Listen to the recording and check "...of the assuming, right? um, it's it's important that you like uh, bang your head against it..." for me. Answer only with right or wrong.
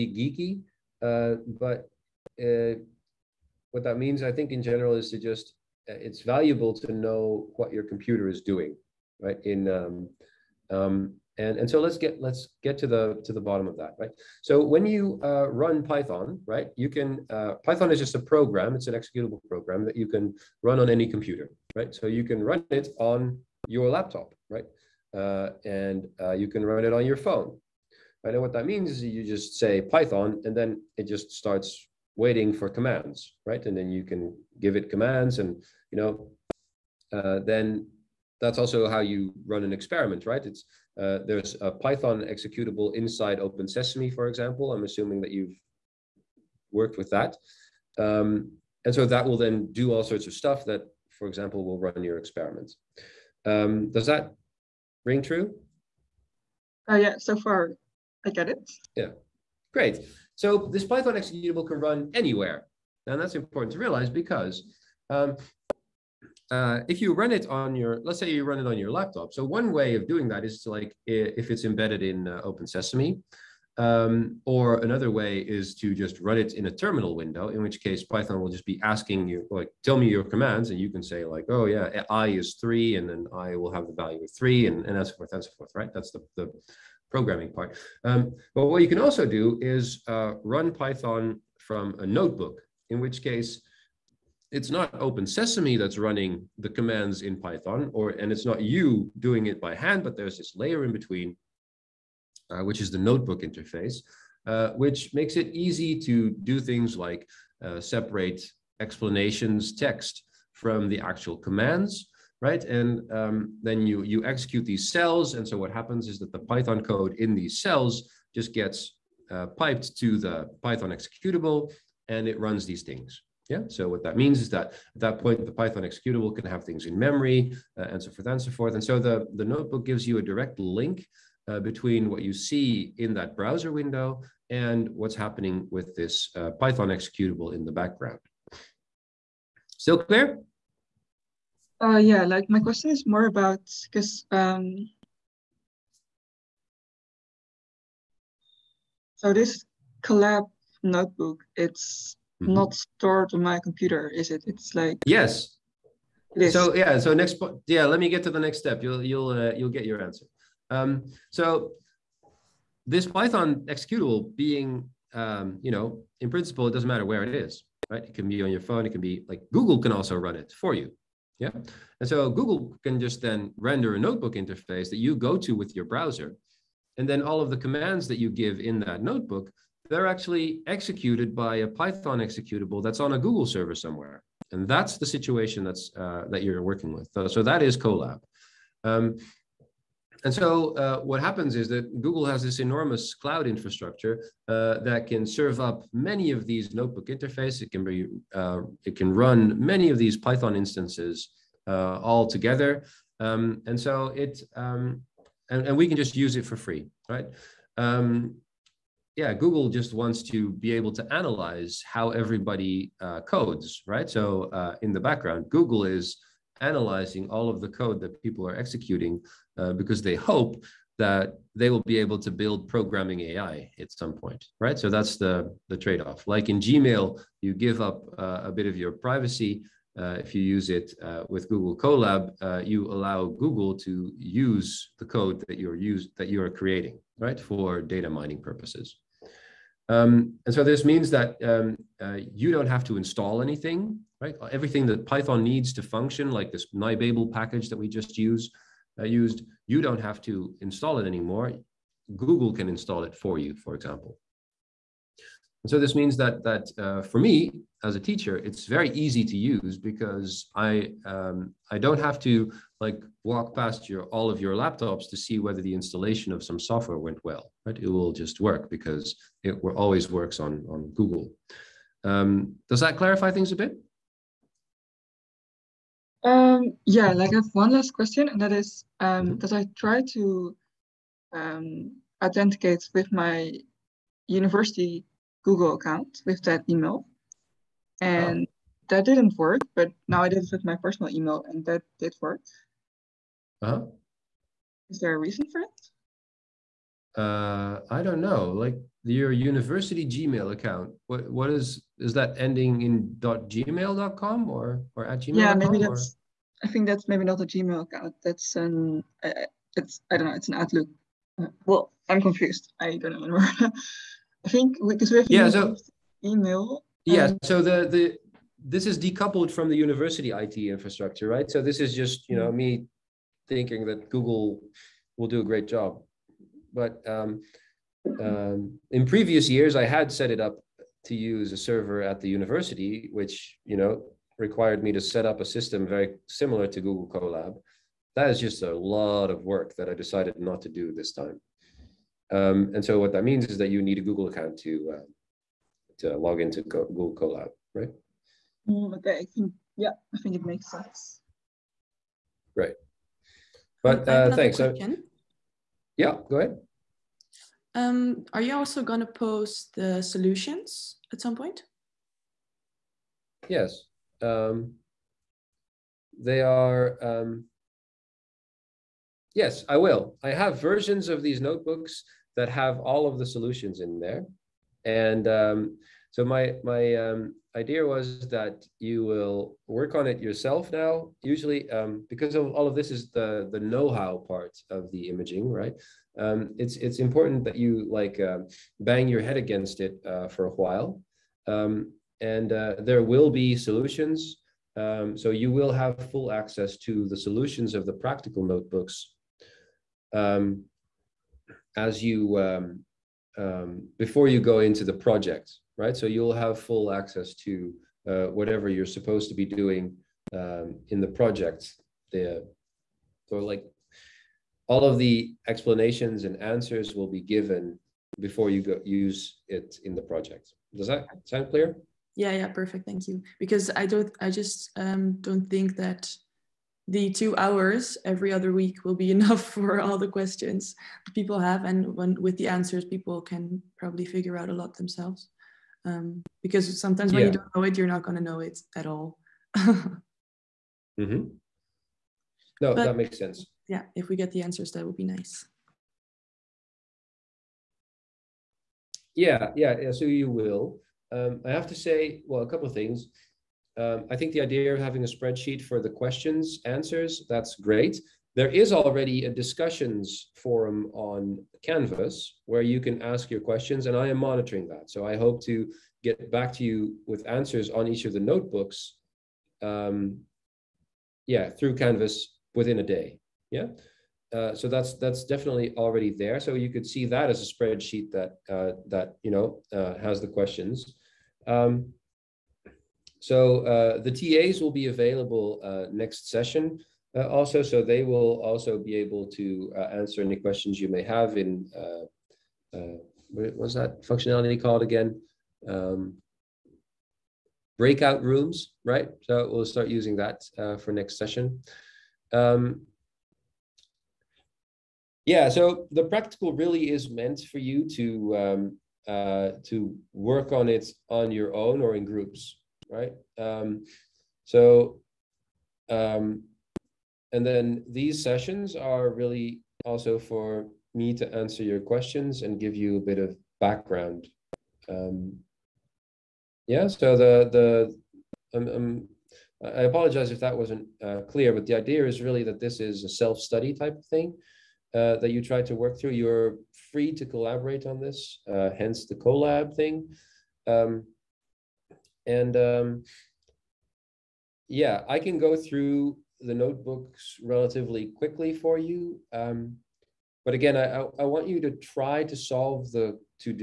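wrong.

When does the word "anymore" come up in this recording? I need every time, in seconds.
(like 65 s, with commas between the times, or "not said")
251 s, 313 s.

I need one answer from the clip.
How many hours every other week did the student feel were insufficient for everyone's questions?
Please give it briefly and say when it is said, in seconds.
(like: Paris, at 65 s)
2 hours, at 427 s.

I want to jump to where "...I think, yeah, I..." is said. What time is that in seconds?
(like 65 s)
349 s.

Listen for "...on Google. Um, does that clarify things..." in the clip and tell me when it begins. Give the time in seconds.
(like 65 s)
270 s.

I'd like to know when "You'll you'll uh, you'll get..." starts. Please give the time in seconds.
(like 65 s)
158 s.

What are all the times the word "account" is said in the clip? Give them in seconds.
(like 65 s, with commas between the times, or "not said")
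285 s, 300 s, 307 s, 344 s.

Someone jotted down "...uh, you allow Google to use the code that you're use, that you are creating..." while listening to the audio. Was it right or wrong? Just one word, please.
right.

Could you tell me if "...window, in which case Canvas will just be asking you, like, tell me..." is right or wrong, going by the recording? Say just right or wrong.
wrong.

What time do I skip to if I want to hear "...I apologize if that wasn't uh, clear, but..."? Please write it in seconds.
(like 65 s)
529 s.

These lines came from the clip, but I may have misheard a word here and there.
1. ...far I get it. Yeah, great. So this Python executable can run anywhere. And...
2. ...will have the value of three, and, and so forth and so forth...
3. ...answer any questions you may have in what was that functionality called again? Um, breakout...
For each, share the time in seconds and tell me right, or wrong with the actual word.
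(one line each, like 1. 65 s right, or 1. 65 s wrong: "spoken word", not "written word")
1. 57 s right
2. 83 s right
3. 490 s right.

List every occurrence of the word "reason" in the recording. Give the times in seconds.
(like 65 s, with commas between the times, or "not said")
295 s.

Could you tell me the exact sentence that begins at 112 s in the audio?
And um, then you, you execute these cells.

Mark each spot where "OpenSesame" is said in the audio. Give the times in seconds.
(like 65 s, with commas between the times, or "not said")
43 s, 72 s, 95 s.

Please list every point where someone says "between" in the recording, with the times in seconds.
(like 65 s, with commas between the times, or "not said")
101 s, 131 s.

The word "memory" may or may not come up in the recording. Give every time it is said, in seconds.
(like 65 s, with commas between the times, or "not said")
126 s.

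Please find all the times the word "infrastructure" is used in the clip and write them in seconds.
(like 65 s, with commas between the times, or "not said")
193 s, 320 s.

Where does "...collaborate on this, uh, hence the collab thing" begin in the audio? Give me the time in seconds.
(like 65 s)
537 s.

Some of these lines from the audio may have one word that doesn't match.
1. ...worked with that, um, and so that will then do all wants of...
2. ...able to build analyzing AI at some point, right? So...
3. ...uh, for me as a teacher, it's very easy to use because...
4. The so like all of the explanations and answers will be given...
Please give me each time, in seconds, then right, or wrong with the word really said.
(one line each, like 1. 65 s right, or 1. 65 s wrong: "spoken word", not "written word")
1. 46 s wrong: "sorts", not "wants"
2. 221 s wrong: "programming", not "analyzing"
3. 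256 s right
4. 412 s right.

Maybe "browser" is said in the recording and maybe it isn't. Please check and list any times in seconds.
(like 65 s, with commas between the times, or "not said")
133 s, 175 s.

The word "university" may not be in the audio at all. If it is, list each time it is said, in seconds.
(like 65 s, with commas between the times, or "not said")
284 s, 299 s, 319 s, 332 s.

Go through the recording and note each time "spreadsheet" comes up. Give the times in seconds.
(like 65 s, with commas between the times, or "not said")
455 s, 477 s.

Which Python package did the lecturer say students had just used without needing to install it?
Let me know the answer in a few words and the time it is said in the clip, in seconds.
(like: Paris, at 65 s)
nibabel, at 246 s.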